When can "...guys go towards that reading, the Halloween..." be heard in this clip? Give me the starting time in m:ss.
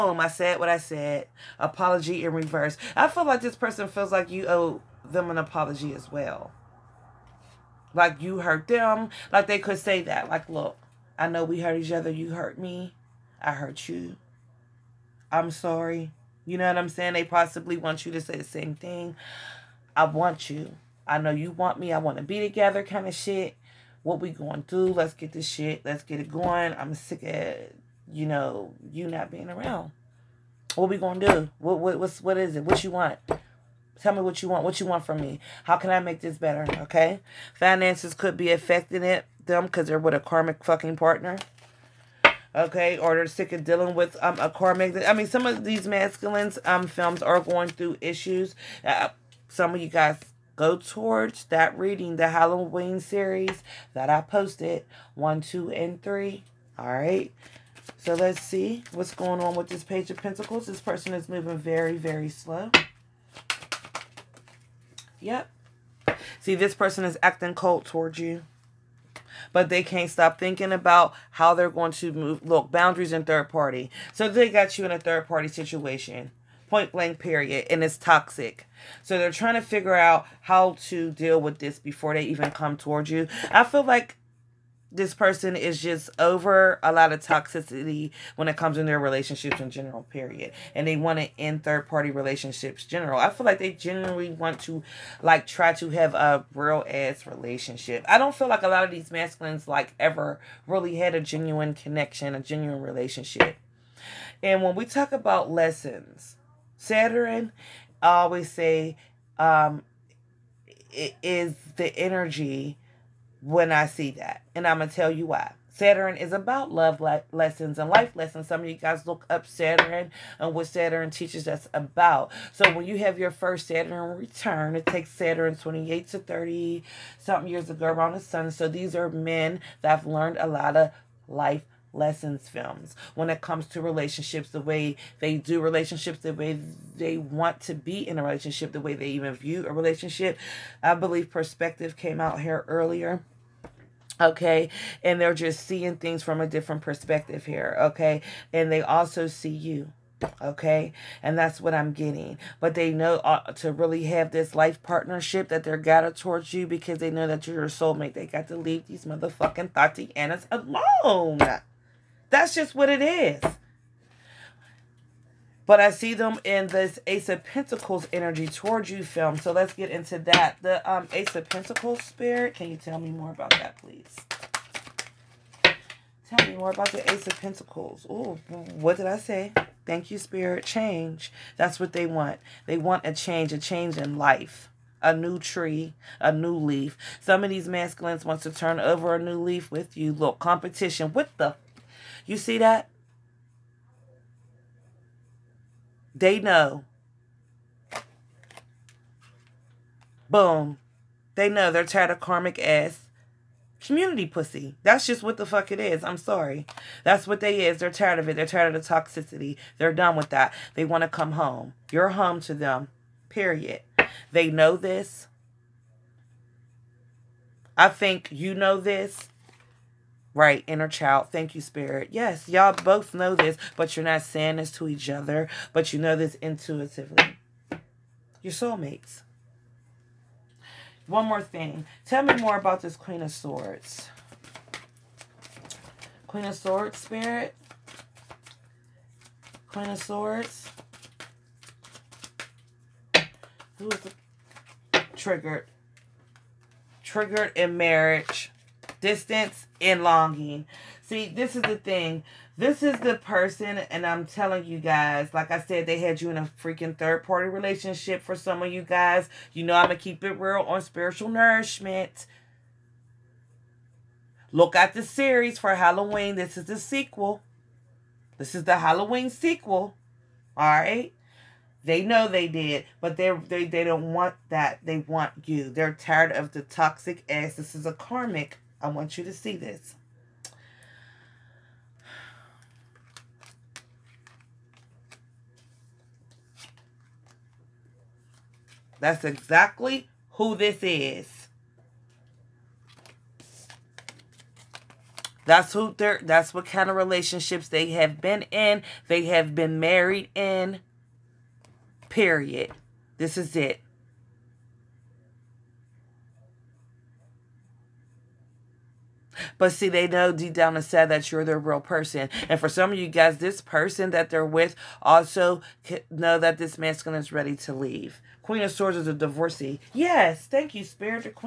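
0:49.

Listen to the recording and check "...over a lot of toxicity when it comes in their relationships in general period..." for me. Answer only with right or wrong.
right.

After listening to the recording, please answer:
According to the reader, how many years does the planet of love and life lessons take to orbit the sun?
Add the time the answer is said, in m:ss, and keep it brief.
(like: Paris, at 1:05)
28 to 30, at 2:05.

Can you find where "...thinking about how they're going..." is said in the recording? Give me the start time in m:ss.
1:10.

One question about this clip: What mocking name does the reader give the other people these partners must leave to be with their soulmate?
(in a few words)
Tatianas.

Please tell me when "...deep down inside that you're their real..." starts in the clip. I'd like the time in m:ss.
5:10.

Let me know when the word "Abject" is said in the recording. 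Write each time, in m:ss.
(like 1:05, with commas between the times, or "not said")
not said.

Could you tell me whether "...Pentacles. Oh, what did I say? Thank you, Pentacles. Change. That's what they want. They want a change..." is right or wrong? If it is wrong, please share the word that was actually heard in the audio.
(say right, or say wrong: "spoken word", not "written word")
wrong: "Spirit", not "Pentacles".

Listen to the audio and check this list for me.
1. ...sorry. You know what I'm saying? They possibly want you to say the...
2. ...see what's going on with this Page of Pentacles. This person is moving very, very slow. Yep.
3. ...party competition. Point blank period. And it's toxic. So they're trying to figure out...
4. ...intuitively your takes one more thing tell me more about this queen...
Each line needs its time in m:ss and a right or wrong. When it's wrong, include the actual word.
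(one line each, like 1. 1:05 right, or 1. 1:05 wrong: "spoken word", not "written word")
1. 0:15 right
2. 0:58 right
3. 1:15 wrong: "situation", not "competition"
4. 3:46 wrong: "soulmates", not "takes".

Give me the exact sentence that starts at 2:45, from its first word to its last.
But I see them in this Ace of Pentacles energy towards you film.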